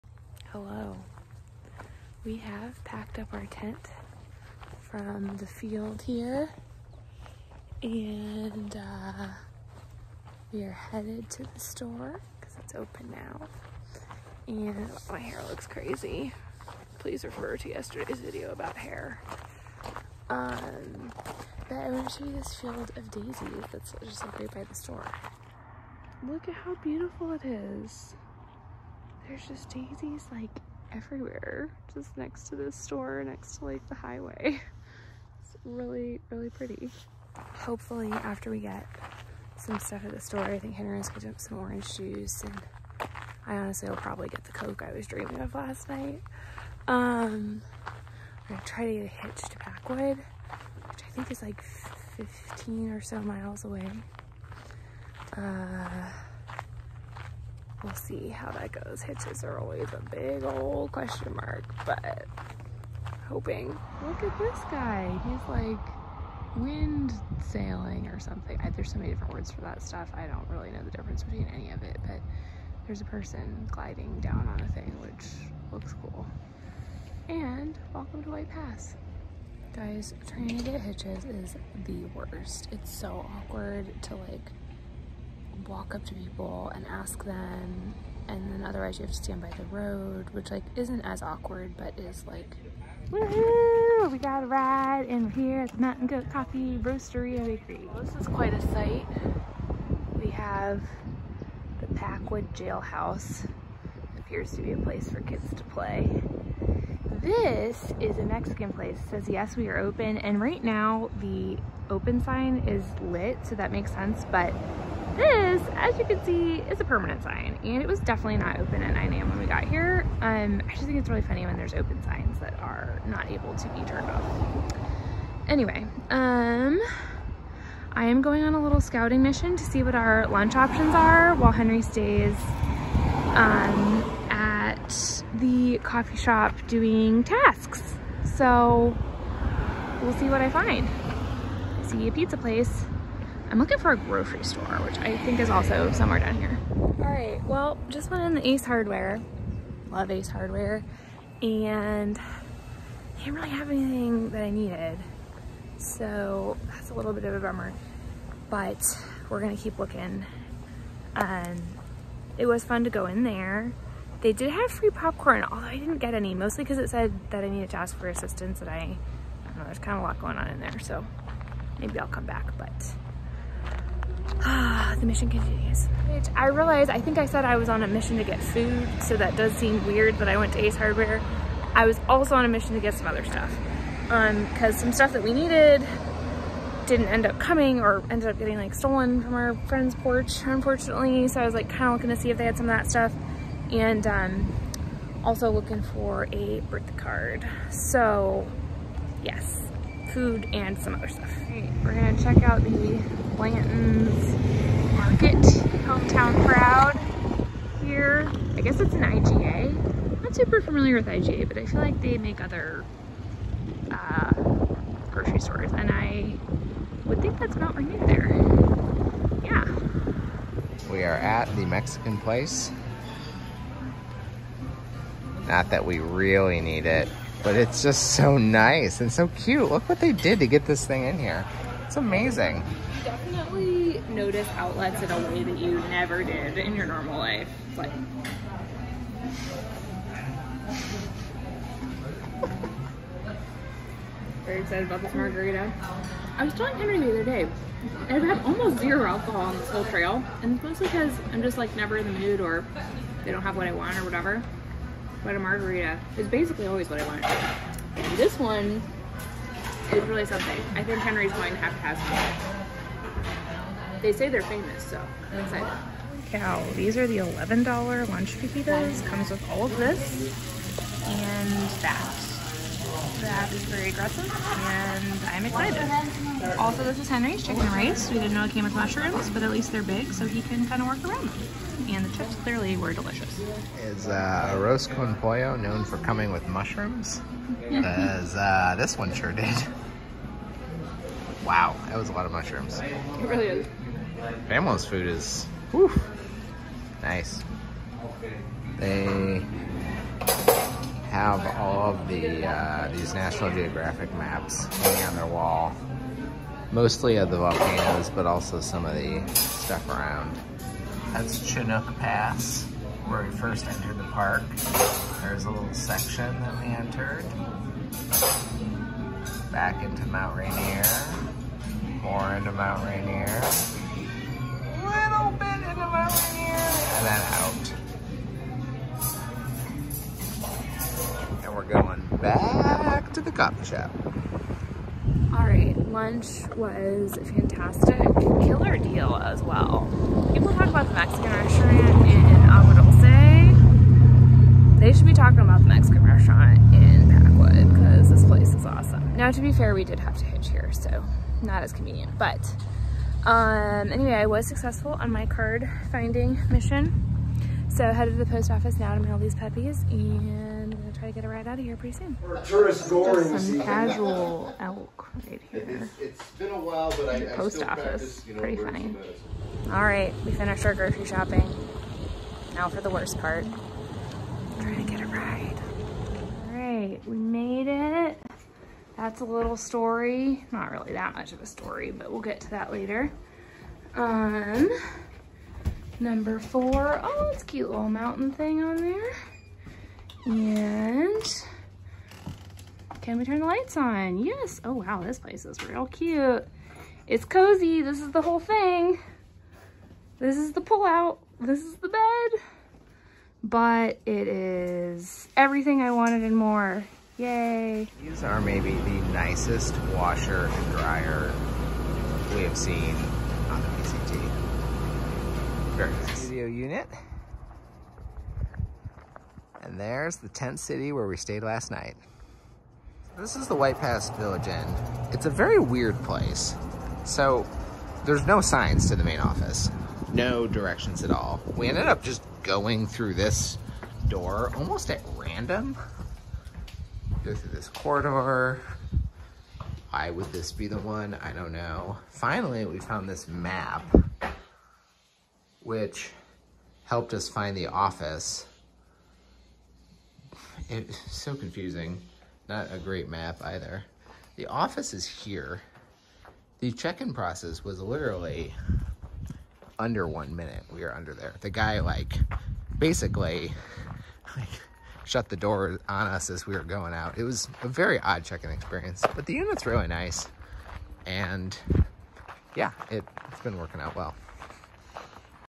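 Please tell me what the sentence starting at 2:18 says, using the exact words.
So we'll see what I find.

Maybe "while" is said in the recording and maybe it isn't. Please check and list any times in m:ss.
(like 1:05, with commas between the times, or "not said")
2:11, 6:06.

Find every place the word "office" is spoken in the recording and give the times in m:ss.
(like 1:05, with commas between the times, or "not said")
5:58, 6:07, 7:09, 7:27, 7:34.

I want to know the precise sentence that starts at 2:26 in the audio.
All right, well, just went in the Ace Hardware.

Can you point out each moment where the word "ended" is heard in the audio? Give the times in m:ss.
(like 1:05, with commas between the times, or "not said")
3:08, 7:11.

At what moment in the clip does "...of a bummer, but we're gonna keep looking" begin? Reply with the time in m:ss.
2:37.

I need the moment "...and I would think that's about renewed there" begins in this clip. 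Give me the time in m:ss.
3:35.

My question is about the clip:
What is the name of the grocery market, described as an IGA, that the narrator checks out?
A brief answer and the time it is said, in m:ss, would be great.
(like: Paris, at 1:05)
Blanton's Market, at 3:23.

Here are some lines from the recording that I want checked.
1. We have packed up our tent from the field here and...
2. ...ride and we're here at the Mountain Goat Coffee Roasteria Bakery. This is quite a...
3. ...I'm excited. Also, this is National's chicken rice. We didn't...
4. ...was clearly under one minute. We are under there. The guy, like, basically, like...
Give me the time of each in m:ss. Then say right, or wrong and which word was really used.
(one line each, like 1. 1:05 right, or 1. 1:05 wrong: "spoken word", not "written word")
1. 0:02 right
2. 1:34 right
3. 4:35 wrong: "Henry", not "National"
4. 7:37 wrong: "literally", not "clearly".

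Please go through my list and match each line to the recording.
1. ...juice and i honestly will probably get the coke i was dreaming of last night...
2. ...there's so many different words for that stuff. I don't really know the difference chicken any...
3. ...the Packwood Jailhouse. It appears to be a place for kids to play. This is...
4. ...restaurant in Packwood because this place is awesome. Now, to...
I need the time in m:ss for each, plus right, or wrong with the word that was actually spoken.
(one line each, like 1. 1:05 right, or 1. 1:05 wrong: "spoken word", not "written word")
1. 0:41 right
2. 1:08 wrong: "between", not "chicken"
3. 1:41 right
4. 5:46 right.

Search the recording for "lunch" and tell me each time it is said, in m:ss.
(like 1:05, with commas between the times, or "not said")
2:10, 4:28, 5:35.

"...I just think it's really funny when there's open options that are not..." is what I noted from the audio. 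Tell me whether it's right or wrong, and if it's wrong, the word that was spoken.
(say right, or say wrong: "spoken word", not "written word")
wrong: "signs", not "options".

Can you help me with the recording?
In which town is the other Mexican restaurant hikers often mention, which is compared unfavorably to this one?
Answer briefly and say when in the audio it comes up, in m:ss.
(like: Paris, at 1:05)
Agua Dulce, at 5:42.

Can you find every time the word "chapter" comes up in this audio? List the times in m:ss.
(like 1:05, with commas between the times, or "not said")
not said.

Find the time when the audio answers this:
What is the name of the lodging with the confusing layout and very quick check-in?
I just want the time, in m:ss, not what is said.
7:03.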